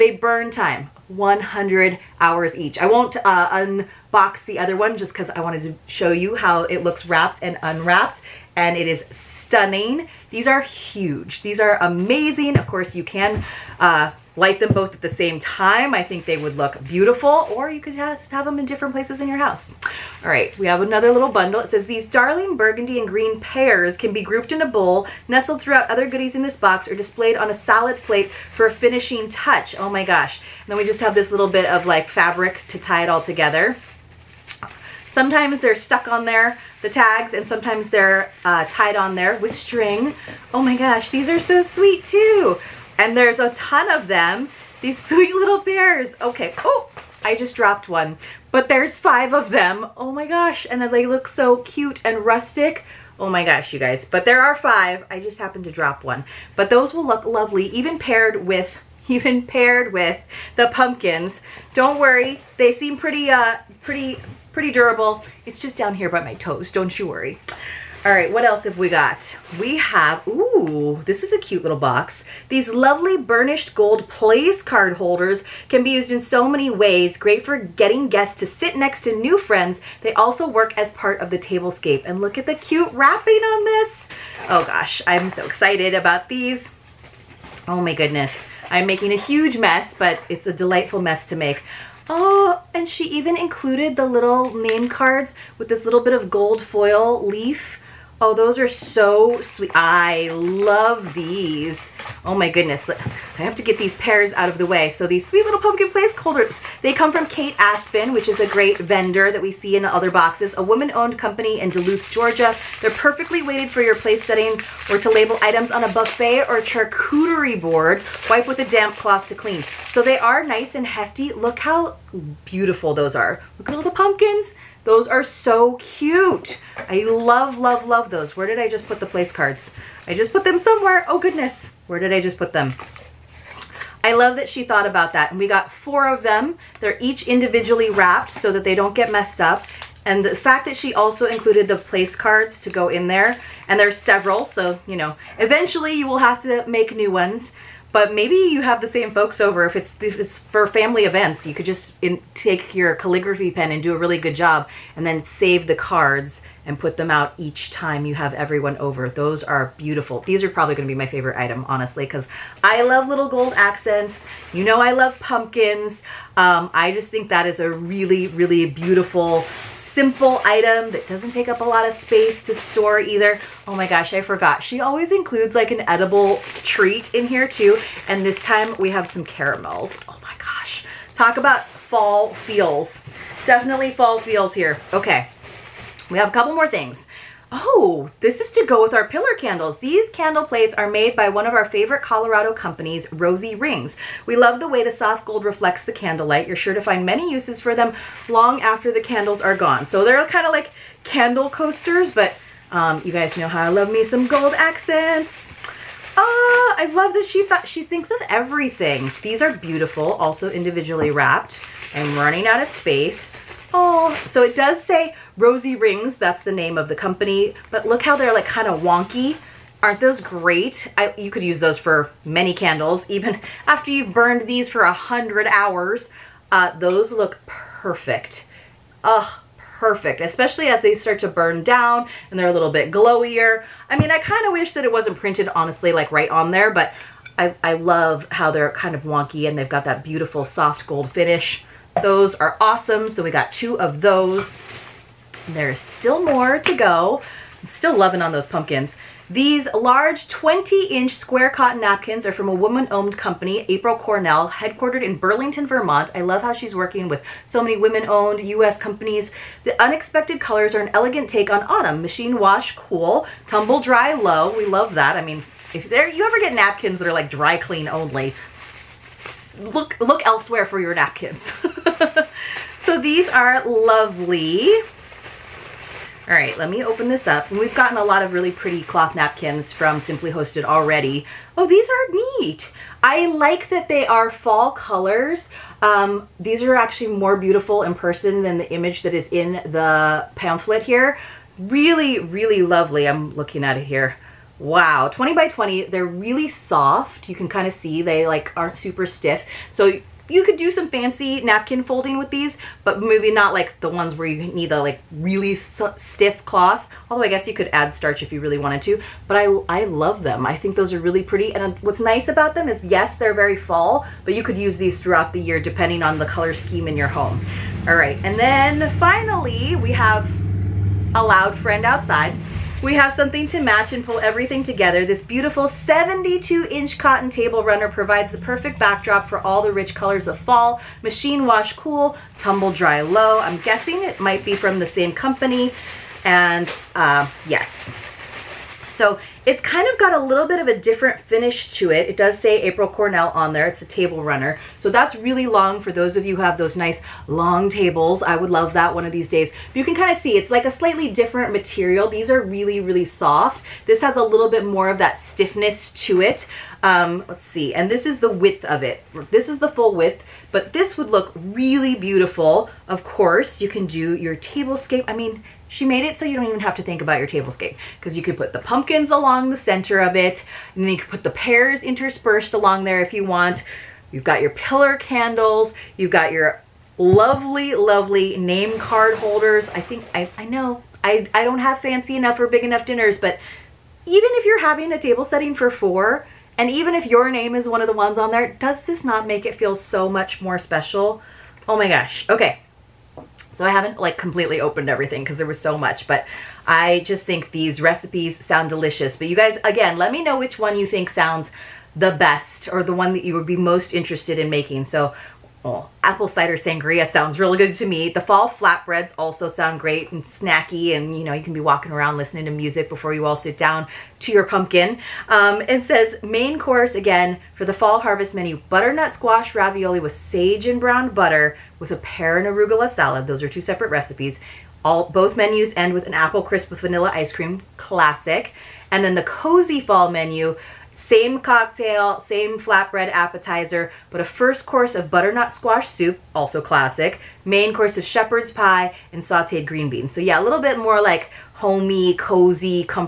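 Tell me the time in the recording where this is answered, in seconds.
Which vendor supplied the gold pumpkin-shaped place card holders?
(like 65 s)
107 s.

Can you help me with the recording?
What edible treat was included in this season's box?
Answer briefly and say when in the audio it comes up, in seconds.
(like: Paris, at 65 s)
Caramels, at 179 s.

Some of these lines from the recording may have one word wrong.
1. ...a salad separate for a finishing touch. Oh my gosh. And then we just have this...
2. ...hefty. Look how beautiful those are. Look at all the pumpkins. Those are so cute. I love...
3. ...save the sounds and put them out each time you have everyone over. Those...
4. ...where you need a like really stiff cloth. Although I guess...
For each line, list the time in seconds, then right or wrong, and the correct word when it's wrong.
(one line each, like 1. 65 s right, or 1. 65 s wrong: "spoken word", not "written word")
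1. 27 s wrong: "plate", not "separate"
2. 120 s right
3. 155 s wrong: "cards", not "sounds"
4. 304 s right.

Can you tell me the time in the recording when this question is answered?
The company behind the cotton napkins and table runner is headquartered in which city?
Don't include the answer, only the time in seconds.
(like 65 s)
255 s.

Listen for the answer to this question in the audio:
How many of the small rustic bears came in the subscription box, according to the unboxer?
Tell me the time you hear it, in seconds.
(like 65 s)
48 s.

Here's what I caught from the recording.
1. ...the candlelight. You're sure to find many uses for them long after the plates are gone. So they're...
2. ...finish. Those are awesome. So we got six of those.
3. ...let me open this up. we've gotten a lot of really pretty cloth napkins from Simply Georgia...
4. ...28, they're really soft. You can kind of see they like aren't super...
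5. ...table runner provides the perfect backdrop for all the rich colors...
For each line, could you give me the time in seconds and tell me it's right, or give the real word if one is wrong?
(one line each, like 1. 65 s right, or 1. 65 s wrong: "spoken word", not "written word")
1. 195 s wrong: "candles", not "plates"
2. 241 s wrong: "two", not "six"
3. 276 s wrong: "Hosted", not "Georgia"
4. 295 s wrong: "20", not "28"
5. 327 s right.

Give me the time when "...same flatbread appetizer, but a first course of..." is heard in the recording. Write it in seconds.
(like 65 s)
432 s.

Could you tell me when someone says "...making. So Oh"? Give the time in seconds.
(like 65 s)
404 s.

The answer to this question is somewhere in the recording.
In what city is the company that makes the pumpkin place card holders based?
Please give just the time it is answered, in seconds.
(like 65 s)
111 s.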